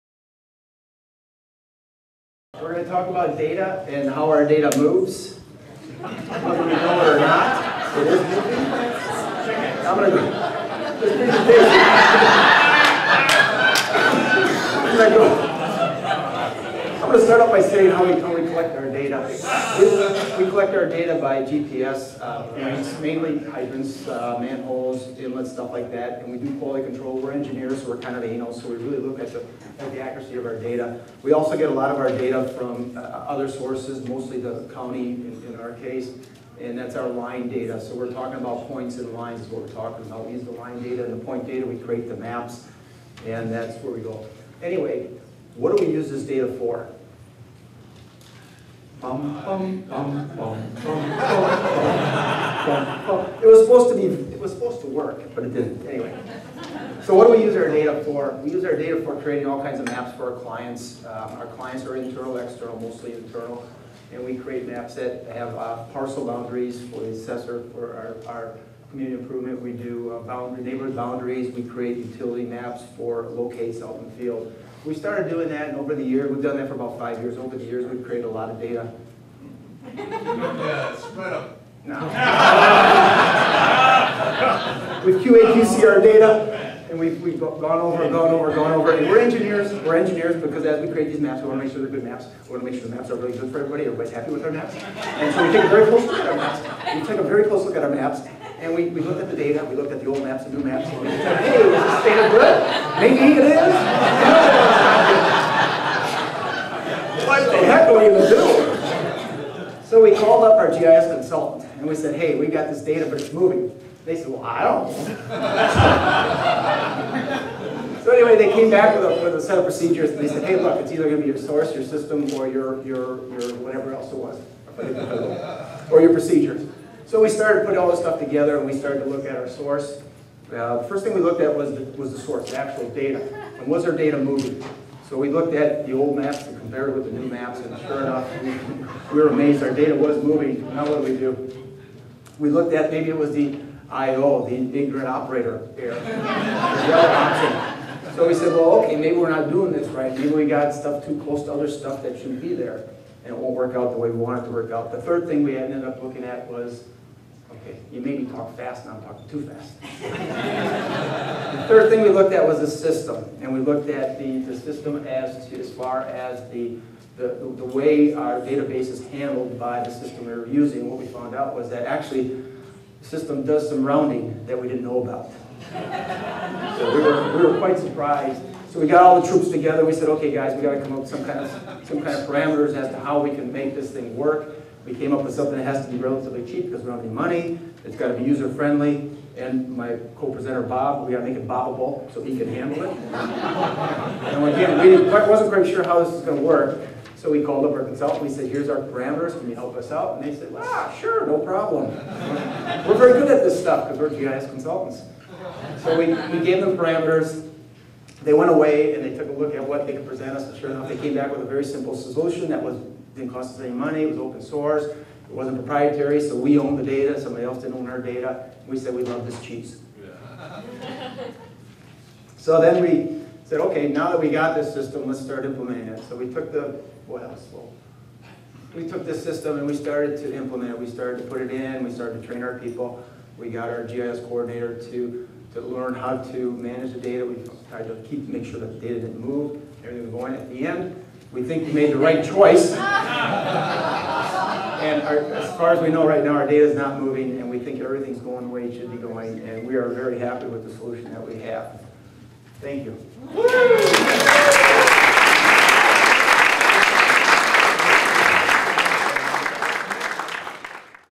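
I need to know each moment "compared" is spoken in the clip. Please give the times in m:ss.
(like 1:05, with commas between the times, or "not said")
2:16.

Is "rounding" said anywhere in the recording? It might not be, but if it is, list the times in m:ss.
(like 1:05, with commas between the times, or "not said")
2:53.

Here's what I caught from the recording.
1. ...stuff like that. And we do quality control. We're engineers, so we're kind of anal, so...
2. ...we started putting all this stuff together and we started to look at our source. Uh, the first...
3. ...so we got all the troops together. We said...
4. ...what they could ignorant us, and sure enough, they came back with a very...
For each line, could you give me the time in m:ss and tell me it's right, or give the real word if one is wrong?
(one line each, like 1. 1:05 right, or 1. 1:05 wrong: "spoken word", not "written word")
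1. 0:25 right
2. 2:07 right
3. 2:58 right
4. 3:29 wrong: "present", not "ignorant".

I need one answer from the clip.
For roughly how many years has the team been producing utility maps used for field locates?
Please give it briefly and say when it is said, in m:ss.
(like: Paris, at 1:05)
5 years, at 1:16.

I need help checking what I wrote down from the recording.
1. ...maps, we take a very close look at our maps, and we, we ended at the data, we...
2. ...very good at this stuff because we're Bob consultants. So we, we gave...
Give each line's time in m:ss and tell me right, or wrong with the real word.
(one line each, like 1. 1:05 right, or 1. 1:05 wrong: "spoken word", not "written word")
1. 1:36 wrong: "looked", not "ended"
2. 3:22 wrong: "GIS", not "Bob".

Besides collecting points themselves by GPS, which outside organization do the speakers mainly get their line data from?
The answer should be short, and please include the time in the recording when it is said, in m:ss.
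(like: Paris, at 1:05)
the county, at 0:34.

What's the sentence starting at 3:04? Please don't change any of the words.
We came up with something that has to be relatively cheap because we don't have any money.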